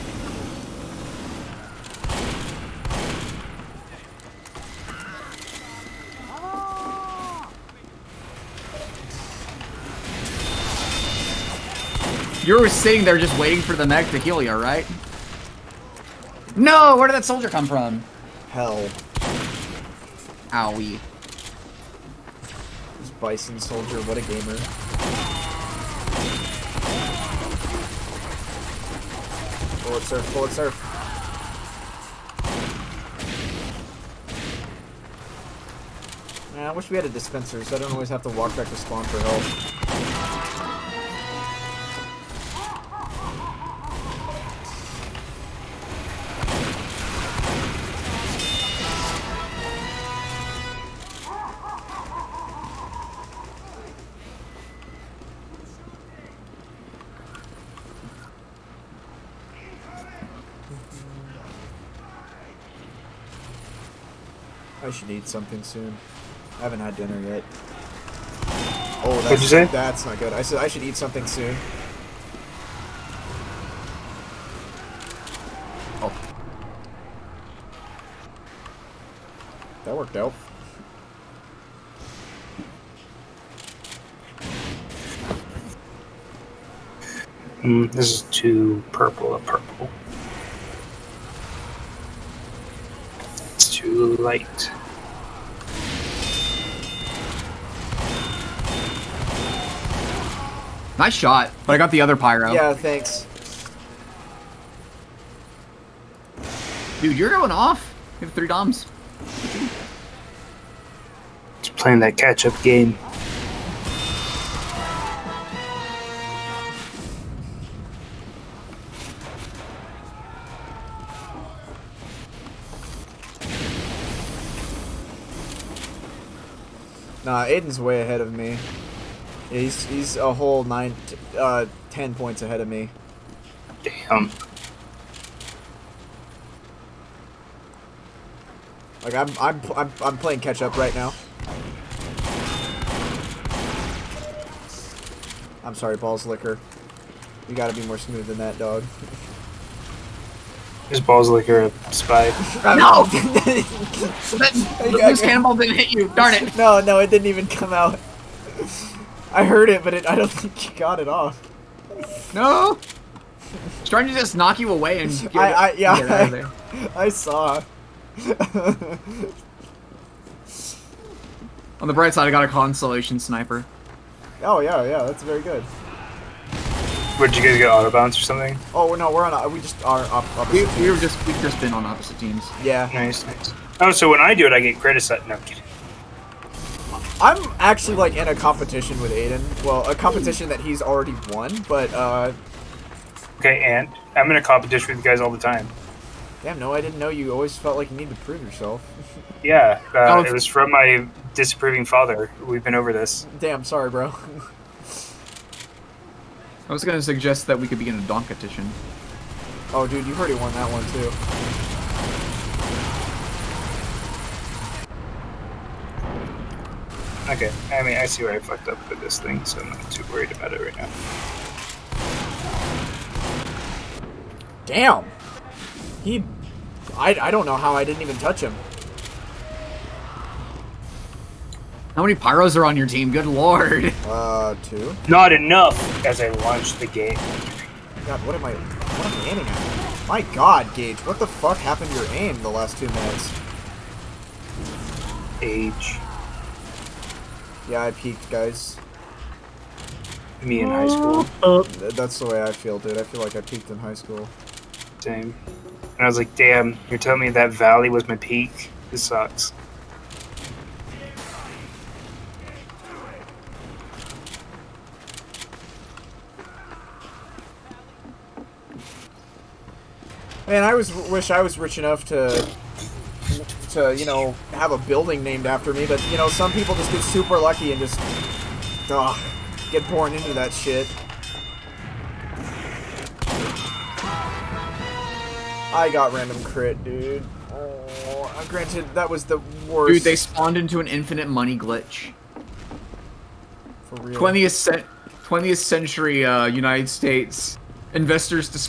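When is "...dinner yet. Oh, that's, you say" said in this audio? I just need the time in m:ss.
1:06.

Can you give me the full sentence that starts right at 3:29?
Oh, dude, you've already won that one too.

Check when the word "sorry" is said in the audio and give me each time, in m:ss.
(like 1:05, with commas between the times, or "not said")
2:25, 3:23.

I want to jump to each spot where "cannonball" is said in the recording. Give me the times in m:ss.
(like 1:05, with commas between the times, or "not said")
2:35.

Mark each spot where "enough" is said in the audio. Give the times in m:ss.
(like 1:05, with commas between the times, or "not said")
3:55, 4:31.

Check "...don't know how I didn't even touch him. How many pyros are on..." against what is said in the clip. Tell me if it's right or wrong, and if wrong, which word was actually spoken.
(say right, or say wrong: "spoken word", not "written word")
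right.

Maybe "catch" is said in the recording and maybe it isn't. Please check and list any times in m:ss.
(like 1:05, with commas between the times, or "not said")
1:52, 2:20.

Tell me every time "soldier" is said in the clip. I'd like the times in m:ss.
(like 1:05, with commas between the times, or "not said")
0:17, 0:23.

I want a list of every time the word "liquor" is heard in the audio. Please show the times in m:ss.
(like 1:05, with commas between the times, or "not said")
2:26, 2:31.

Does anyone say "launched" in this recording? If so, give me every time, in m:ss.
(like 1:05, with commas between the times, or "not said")
3:56.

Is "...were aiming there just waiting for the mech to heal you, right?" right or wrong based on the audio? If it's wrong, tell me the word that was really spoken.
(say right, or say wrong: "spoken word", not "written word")
wrong: "sitting", not "aiming".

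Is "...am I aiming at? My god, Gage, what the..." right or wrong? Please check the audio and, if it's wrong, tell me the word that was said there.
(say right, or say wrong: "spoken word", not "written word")
right.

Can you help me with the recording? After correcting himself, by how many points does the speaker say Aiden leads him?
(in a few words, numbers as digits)
10.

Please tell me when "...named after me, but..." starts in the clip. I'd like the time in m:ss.
4:35.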